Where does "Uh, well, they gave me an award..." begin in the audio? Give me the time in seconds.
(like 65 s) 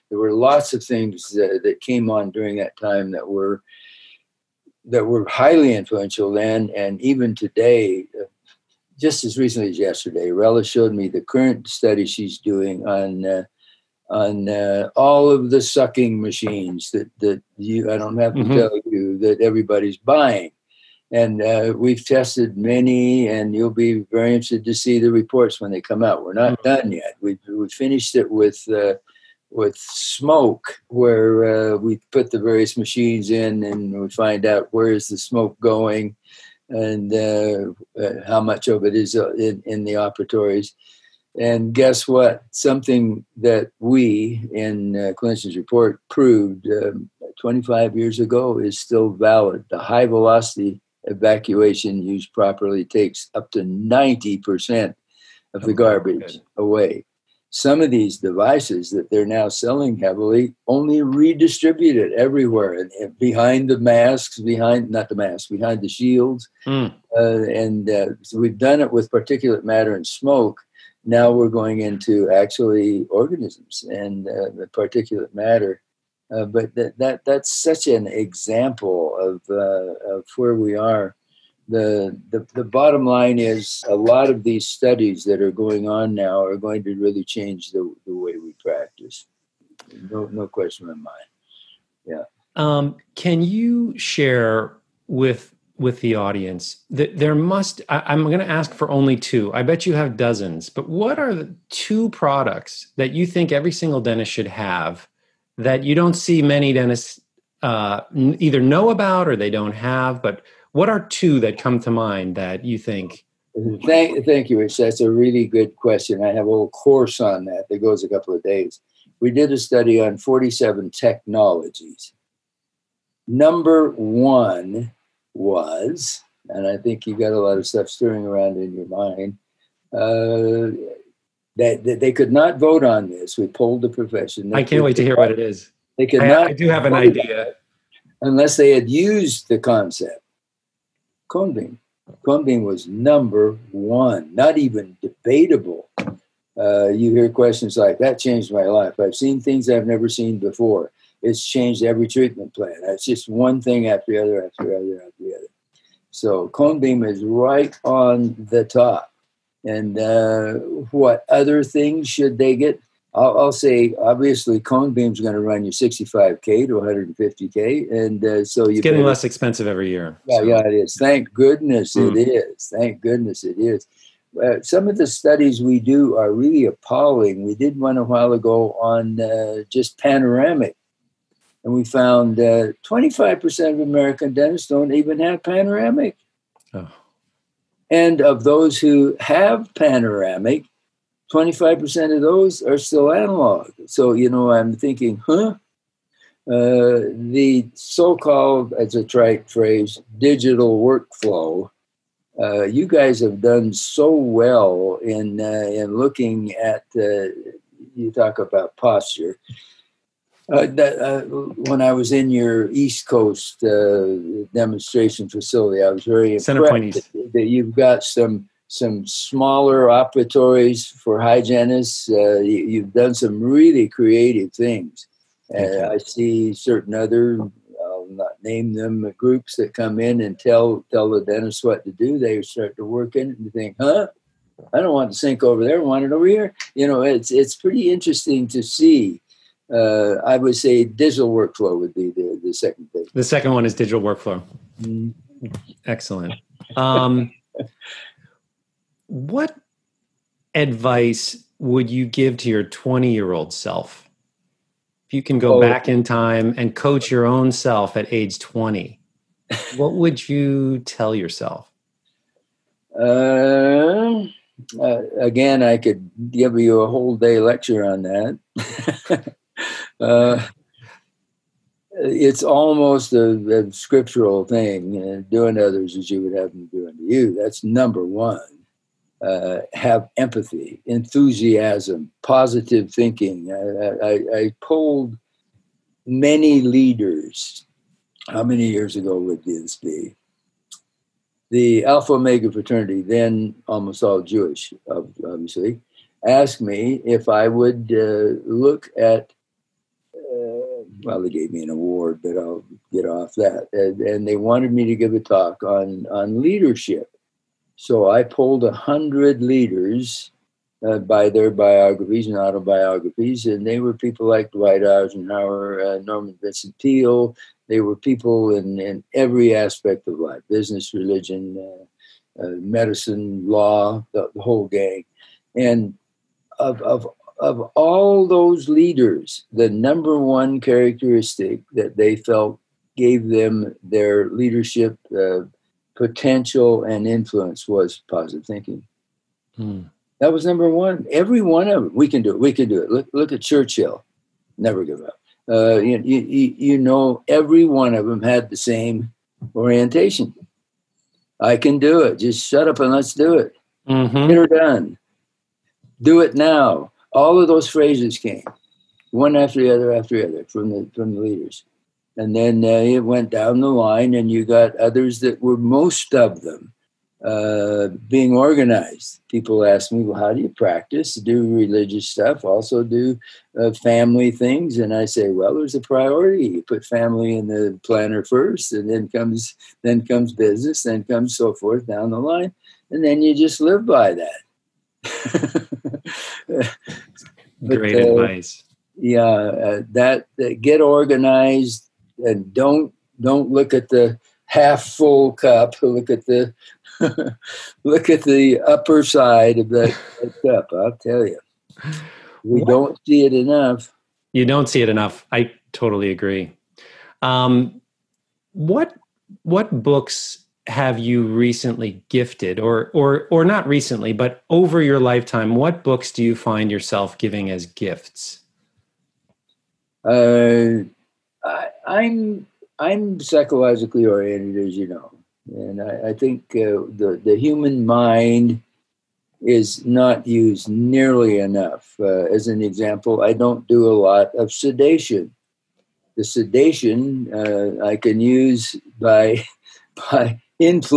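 300 s.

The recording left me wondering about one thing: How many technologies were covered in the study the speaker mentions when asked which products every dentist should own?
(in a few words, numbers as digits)
47.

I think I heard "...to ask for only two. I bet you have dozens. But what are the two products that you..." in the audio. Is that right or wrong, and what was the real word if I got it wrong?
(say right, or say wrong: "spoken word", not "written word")
right.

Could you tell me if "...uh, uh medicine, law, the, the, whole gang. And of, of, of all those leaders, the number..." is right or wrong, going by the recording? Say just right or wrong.
right.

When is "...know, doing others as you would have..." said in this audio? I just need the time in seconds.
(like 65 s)
275 s.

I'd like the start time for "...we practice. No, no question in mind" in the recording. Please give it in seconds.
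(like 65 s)
88 s.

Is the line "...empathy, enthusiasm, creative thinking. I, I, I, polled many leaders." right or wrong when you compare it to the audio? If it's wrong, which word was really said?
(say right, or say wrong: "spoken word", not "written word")
wrong: "positive", not "creative".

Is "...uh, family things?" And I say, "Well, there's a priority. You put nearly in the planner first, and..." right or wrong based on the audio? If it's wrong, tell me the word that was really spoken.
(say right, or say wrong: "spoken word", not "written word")
wrong: "family", not "nearly".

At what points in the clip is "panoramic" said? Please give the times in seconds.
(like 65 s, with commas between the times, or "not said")
179 s, 185 s, 189 s.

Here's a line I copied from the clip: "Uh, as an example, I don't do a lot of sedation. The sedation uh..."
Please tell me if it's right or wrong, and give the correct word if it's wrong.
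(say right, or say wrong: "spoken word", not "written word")
right.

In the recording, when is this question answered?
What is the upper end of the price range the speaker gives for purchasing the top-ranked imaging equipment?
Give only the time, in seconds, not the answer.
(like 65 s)
166 s.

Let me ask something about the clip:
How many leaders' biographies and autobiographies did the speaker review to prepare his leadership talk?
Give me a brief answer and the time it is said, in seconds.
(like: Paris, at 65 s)
100, at 308 s.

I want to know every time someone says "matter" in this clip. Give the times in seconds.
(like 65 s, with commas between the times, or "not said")
69 s, 75 s.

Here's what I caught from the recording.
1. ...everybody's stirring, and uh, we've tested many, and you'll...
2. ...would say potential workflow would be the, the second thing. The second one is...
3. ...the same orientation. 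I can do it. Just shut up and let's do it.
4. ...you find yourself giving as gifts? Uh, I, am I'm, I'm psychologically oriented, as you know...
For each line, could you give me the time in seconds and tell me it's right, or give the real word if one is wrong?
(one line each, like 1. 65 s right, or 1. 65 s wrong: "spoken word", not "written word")
1. 19 s wrong: "buying", not "stirring"
2. 240 s wrong: "digital", not "potential"
3. 348 s right
4. 416 s right.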